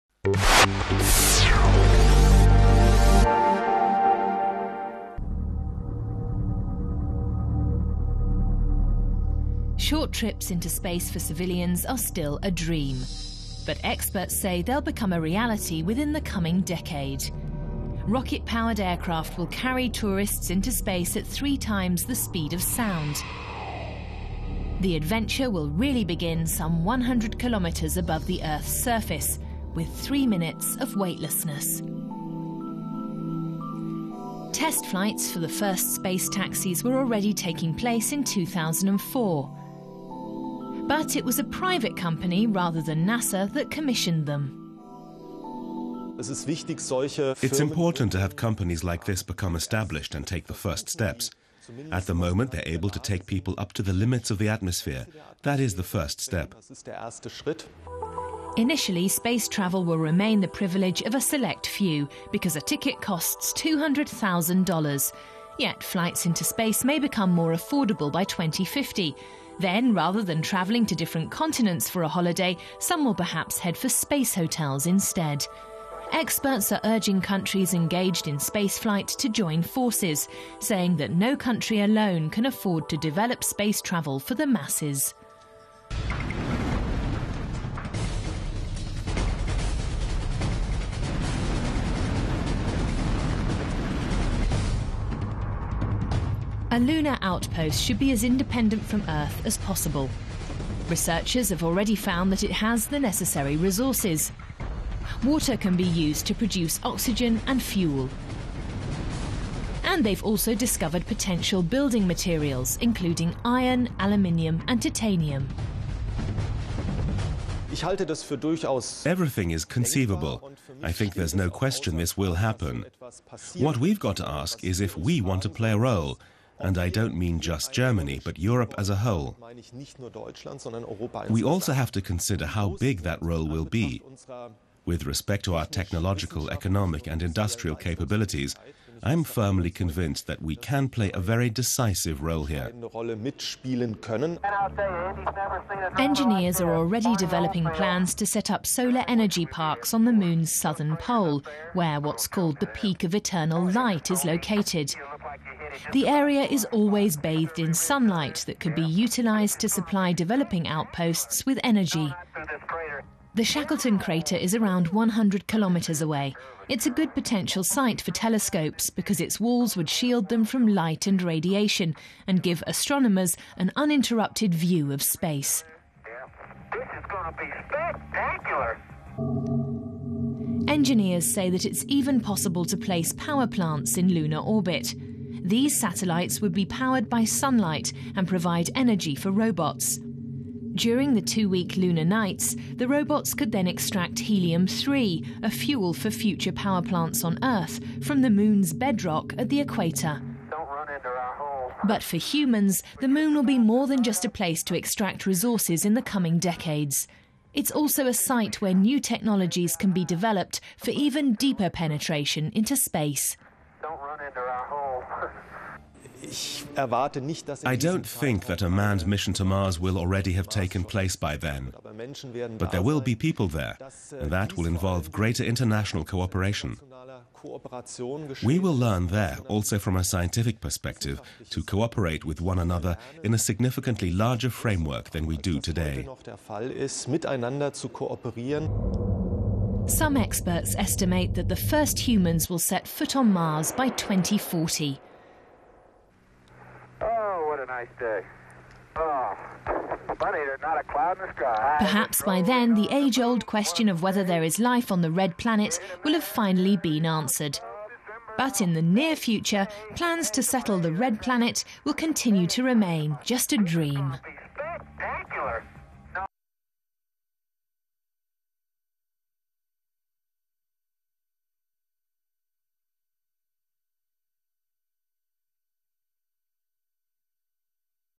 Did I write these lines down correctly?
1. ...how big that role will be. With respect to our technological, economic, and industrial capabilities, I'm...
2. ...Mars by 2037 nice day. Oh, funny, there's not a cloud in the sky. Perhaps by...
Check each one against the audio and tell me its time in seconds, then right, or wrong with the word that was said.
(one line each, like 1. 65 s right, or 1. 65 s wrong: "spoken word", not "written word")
1. 132 s right
2. 243 s wrong: "2040", not "2037".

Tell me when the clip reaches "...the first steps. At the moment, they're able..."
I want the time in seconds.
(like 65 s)
50 s.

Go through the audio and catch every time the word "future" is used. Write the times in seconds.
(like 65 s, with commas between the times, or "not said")
196 s, 259 s.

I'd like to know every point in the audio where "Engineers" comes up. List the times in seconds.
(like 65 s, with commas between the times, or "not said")
145 s, 180 s.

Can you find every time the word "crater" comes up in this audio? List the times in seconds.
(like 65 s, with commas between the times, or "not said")
163 s.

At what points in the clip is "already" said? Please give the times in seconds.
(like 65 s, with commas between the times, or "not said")
36 s, 101 s, 146 s, 219 s.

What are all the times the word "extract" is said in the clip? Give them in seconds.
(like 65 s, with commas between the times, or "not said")
193 s, 204 s.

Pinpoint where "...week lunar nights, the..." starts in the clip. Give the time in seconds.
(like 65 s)
191 s.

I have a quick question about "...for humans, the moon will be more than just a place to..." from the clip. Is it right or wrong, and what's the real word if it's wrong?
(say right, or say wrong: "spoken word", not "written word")
right.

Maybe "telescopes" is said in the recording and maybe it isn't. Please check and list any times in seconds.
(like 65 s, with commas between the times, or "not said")
168 s.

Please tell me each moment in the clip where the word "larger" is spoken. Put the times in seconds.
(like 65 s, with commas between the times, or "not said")
234 s.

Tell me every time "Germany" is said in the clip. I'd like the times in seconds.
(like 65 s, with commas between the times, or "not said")
127 s.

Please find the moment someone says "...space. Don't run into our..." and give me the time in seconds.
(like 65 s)
212 s.